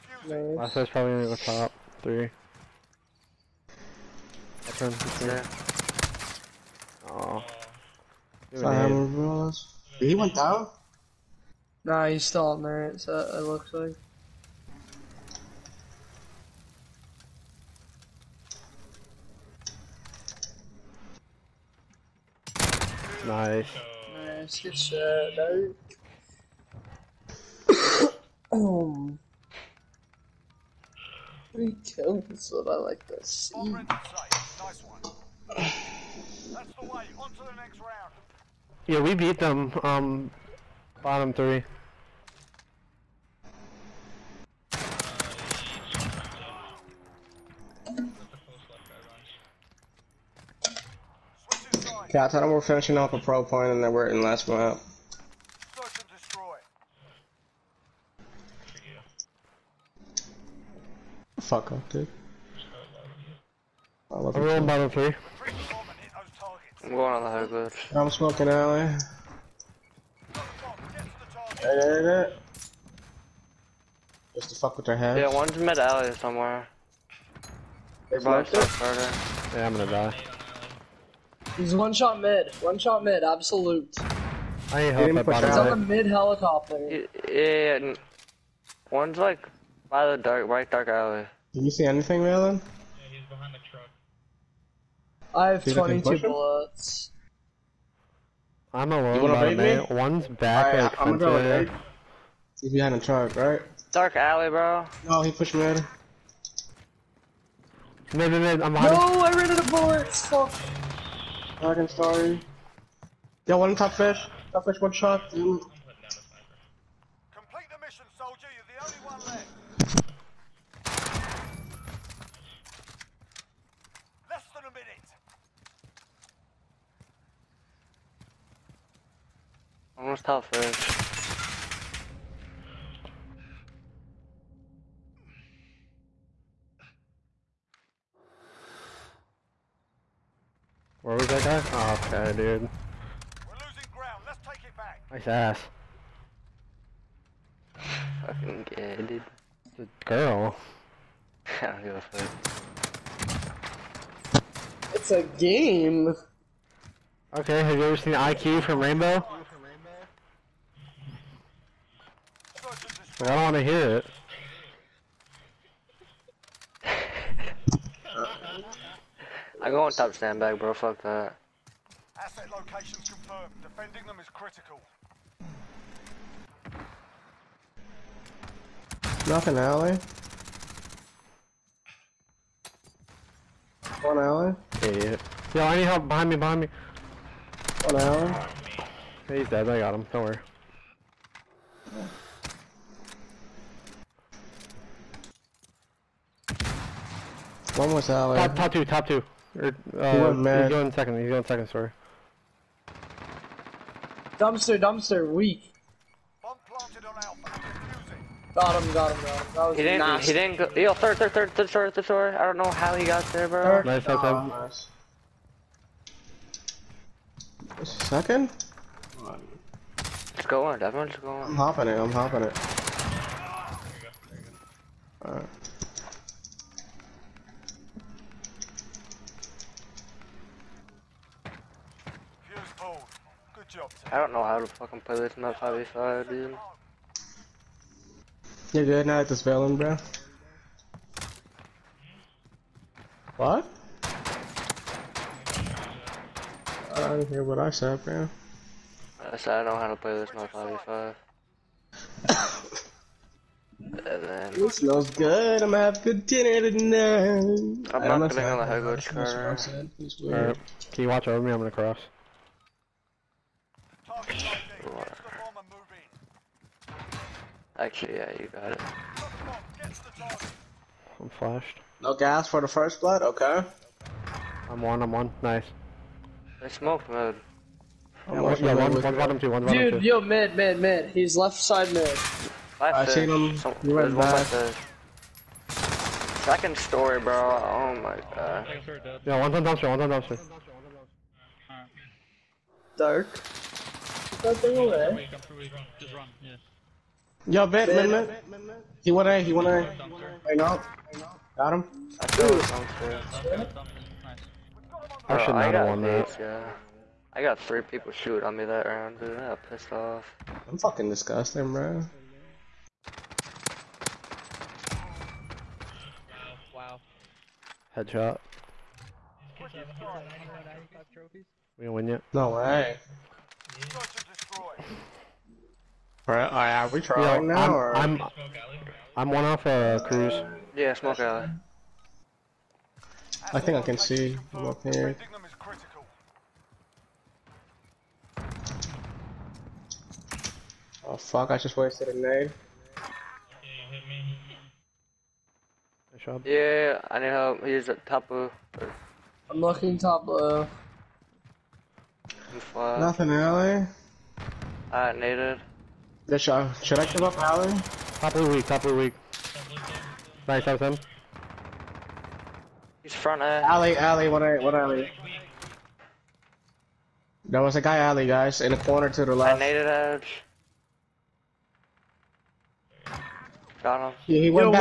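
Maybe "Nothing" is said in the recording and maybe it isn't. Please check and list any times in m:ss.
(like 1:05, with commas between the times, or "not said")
2:59, 5:52.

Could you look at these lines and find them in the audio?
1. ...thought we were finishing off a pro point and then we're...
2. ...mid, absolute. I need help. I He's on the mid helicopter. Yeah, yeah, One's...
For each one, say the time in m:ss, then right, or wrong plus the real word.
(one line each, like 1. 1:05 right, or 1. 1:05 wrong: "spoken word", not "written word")
1. 0:52 right
2. 1:23 right.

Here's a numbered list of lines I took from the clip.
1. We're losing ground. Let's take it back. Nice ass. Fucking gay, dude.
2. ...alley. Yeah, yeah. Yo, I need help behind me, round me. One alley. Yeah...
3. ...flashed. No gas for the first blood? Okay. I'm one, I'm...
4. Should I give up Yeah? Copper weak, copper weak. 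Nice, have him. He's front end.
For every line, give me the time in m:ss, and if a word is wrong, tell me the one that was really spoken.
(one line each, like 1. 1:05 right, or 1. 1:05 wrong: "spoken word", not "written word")
1. 2:22 right
2. 3:04 wrong: "behind", not "round"
3. 4:31 right
4. 5:56 wrong: "Alley", not "Yeah".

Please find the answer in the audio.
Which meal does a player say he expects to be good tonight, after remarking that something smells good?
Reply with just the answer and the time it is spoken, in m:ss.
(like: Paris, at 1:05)
dinner, at 4:16.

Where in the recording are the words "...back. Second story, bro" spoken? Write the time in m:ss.
4:44.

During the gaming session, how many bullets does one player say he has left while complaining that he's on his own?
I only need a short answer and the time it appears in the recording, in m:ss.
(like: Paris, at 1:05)
22, at 1:36.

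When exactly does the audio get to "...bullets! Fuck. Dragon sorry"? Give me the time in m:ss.
1:49.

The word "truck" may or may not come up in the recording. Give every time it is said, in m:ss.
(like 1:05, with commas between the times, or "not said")
1:33, 1:42.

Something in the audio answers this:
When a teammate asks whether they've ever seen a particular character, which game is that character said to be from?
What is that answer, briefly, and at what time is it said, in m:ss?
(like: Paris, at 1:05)
Rainbow, at 2:38.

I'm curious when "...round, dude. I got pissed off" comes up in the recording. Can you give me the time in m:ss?
5:08.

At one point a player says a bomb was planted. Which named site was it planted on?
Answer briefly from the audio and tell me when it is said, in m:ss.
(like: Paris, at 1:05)
Alpha, at 3:27.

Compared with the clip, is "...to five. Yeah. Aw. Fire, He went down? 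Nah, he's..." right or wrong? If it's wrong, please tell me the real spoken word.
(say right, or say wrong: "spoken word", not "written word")
wrong: "three", not "five".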